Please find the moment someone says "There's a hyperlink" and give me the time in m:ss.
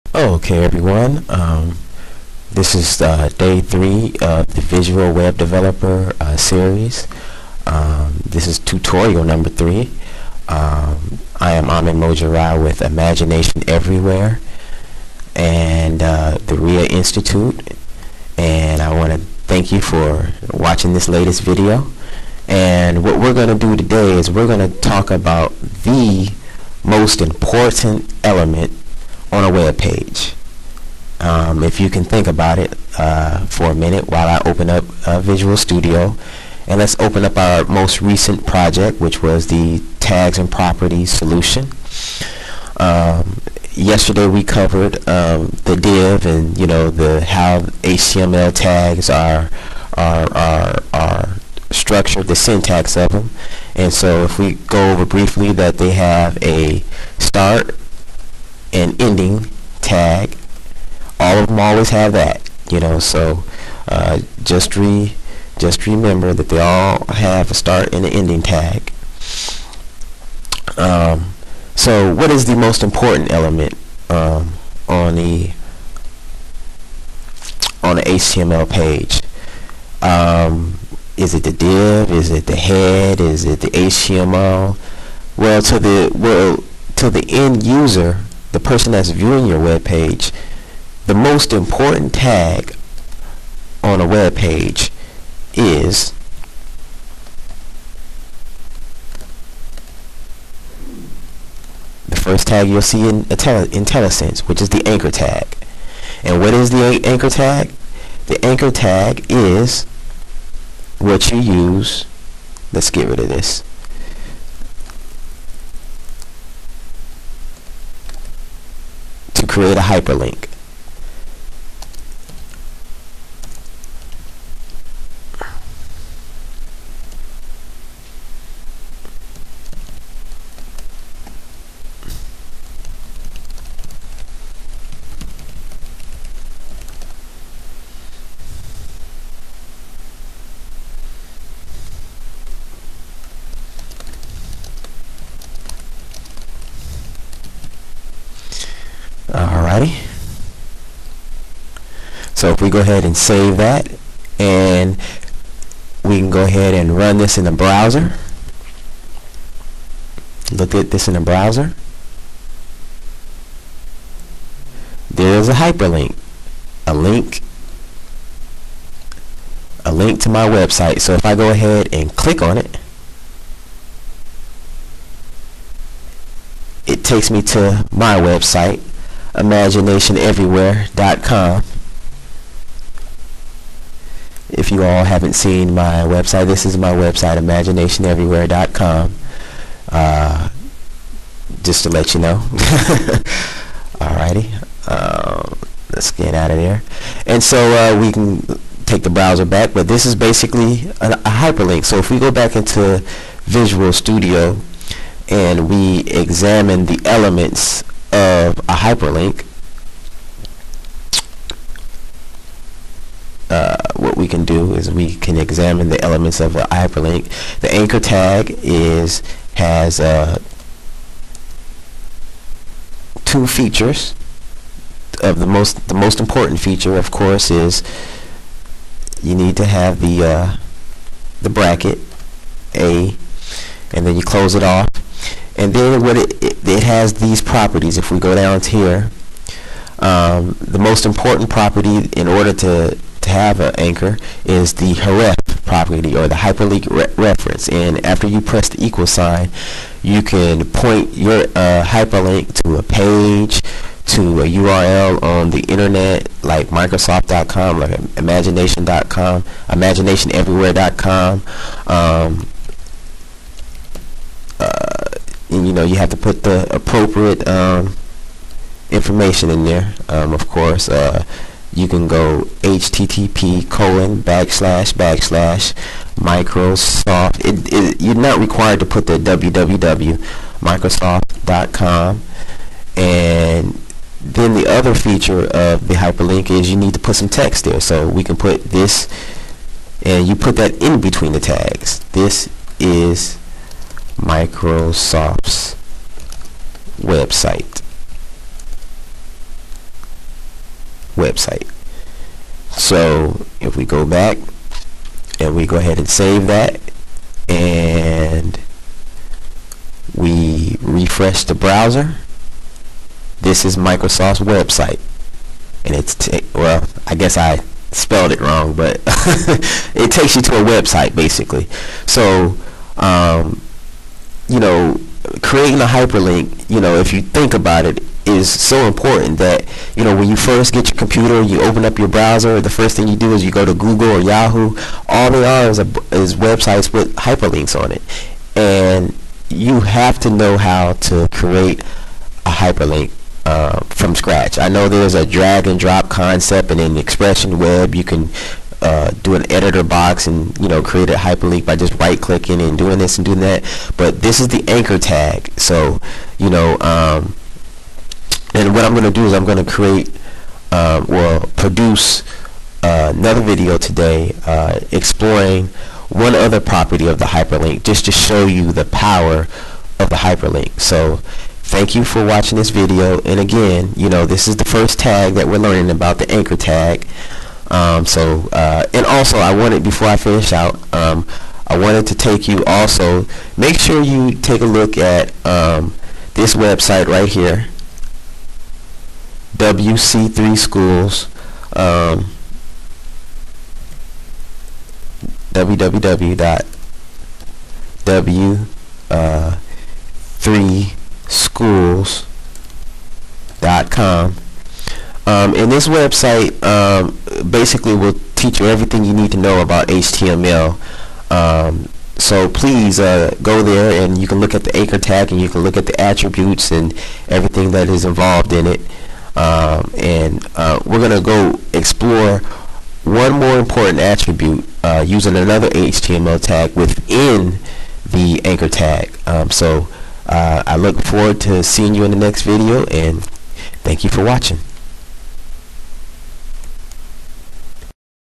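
2:45.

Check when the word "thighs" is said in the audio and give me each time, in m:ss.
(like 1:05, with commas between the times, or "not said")
not said.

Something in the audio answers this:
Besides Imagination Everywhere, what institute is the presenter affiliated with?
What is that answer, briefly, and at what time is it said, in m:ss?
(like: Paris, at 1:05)
RIA Institute, at 0:16.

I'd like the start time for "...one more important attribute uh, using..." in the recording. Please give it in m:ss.
7:03.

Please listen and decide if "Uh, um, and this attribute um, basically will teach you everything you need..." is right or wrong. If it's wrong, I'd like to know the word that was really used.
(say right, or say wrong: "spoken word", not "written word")
wrong: "website", not "attribute".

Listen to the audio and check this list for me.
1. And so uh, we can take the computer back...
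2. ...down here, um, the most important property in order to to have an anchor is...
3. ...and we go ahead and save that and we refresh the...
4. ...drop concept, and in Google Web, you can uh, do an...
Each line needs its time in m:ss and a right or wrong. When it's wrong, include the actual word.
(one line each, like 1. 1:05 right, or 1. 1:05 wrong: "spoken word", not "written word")
1. 3:17 wrong: "browser", not "computer"
2. 3:58 right
3. 5:05 right
4. 5:45 wrong: "Expression", not "Google".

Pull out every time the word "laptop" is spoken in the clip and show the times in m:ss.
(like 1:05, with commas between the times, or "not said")
not said.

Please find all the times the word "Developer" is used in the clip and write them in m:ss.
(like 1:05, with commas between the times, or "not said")
0:05.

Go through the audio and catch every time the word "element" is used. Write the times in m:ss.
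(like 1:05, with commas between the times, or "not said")
0:28, 1:13, 3:27, 3:36.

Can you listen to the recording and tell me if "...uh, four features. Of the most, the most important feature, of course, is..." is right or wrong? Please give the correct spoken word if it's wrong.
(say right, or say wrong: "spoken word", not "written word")
wrong: "two", not "four".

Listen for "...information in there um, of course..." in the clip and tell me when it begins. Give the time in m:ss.
4:28.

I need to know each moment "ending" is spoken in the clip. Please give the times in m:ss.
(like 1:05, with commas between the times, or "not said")
0:59, 1:08.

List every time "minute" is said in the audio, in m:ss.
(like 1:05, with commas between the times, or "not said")
0:33.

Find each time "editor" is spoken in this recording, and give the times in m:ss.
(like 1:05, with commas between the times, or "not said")
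5:49.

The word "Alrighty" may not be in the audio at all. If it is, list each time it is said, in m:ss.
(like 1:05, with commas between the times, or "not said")
2:29, 3:13.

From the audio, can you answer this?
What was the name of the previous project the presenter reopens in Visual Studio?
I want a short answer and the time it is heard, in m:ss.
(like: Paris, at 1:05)
tags and properties, at 0:39.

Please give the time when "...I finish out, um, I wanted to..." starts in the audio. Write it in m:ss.
6:20.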